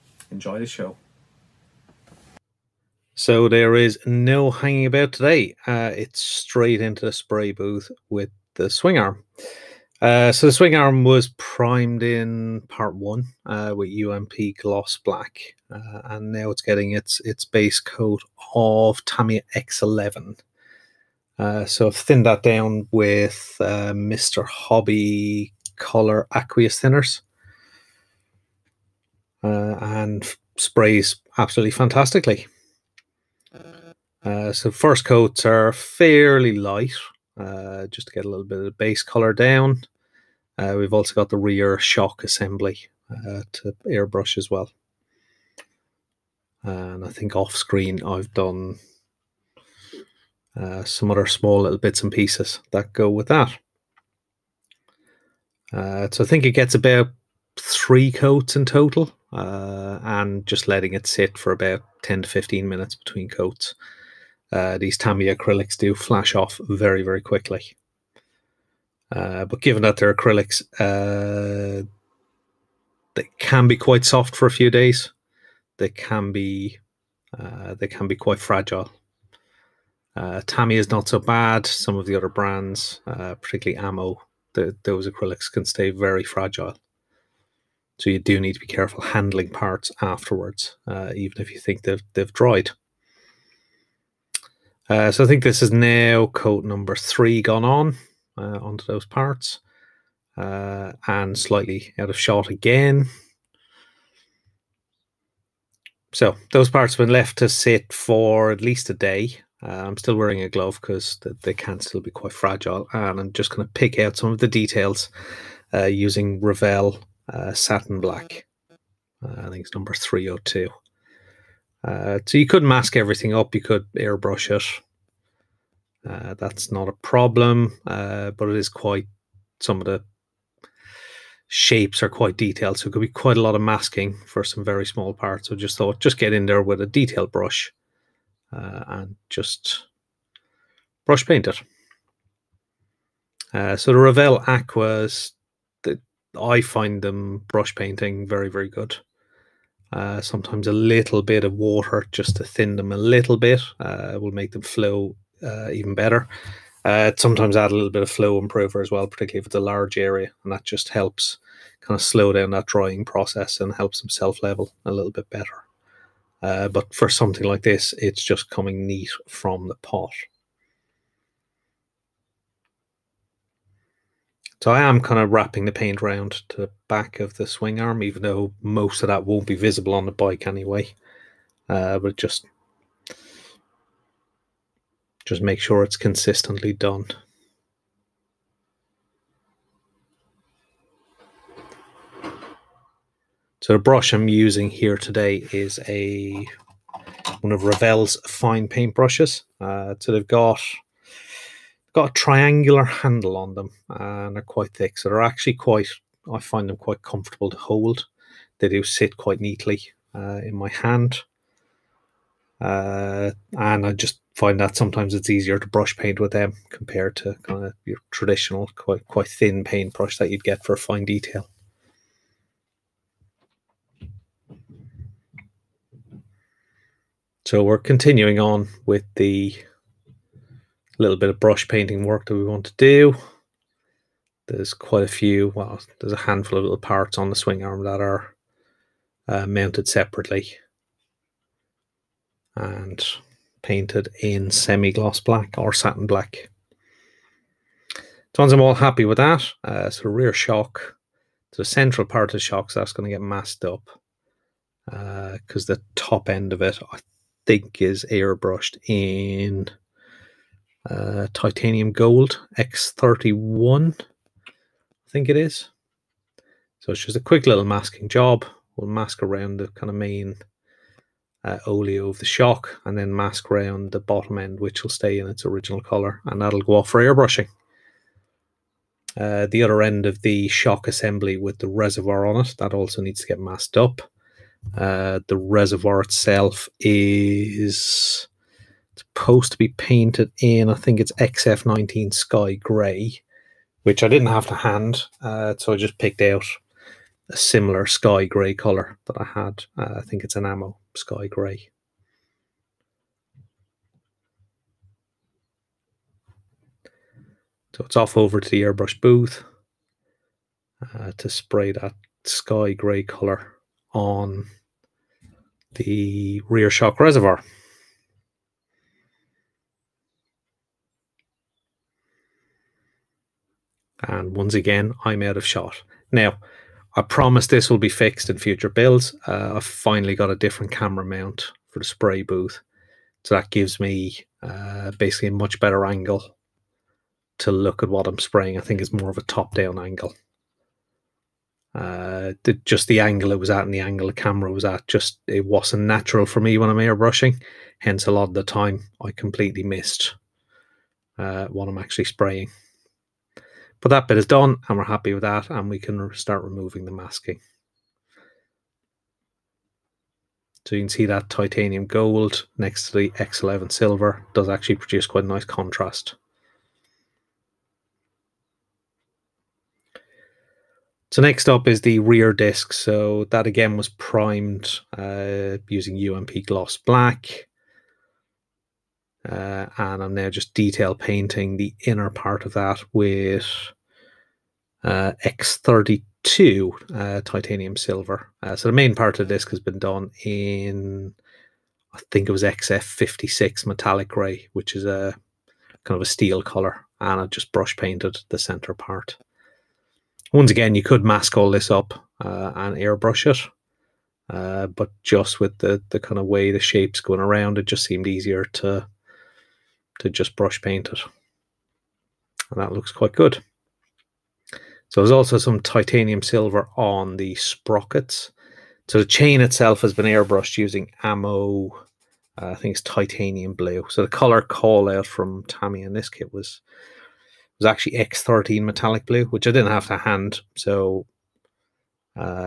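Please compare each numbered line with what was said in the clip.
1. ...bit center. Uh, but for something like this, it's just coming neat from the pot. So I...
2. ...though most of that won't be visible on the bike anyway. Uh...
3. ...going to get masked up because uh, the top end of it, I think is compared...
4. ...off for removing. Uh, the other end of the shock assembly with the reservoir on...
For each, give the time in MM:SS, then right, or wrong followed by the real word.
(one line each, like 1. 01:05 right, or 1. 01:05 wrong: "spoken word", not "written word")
1. 02:45 wrong: "better", not "center"
2. 02:58 right
3. 04:12 wrong: "airbrushed", not "compared"
4. 04:36 wrong: "airbrushing", not "removing".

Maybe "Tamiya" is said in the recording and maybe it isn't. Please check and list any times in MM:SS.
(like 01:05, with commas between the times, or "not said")
00:19, 01:04, 01:20, 07:05.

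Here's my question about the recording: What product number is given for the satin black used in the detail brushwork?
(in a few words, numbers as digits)
302.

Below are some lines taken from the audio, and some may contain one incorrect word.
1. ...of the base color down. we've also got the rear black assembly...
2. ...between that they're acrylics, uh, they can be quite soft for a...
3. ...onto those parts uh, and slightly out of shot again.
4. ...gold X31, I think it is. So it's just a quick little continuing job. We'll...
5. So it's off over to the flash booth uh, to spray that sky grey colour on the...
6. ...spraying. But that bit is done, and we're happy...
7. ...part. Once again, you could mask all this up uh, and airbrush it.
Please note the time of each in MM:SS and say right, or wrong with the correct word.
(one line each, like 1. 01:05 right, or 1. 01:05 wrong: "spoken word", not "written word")
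1. 00:38 wrong: "shock", not "black"
2. 01:09 wrong: "given", not "between"
3. 01:38 right
4. 04:21 wrong: "masking", not "continuing"
5. 05:07 wrong: "airbrush", not "flash"
6. 05:52 right
7. 06:38 right.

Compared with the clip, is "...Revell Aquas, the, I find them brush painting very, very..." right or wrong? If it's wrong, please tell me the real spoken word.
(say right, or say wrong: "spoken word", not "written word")
right.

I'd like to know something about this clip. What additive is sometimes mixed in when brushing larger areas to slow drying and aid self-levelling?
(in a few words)
flow improver.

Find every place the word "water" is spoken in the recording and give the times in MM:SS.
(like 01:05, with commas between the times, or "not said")
02:31.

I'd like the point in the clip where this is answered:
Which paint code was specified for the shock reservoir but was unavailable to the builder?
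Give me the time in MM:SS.
04:51.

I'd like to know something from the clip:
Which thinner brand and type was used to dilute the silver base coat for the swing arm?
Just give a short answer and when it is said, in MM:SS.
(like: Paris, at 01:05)
Mr. Hobby Color Aqueous Thinners, at 00:23.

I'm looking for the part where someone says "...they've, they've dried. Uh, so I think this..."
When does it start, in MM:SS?
01:31.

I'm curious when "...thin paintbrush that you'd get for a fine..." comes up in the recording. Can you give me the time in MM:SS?
03:39.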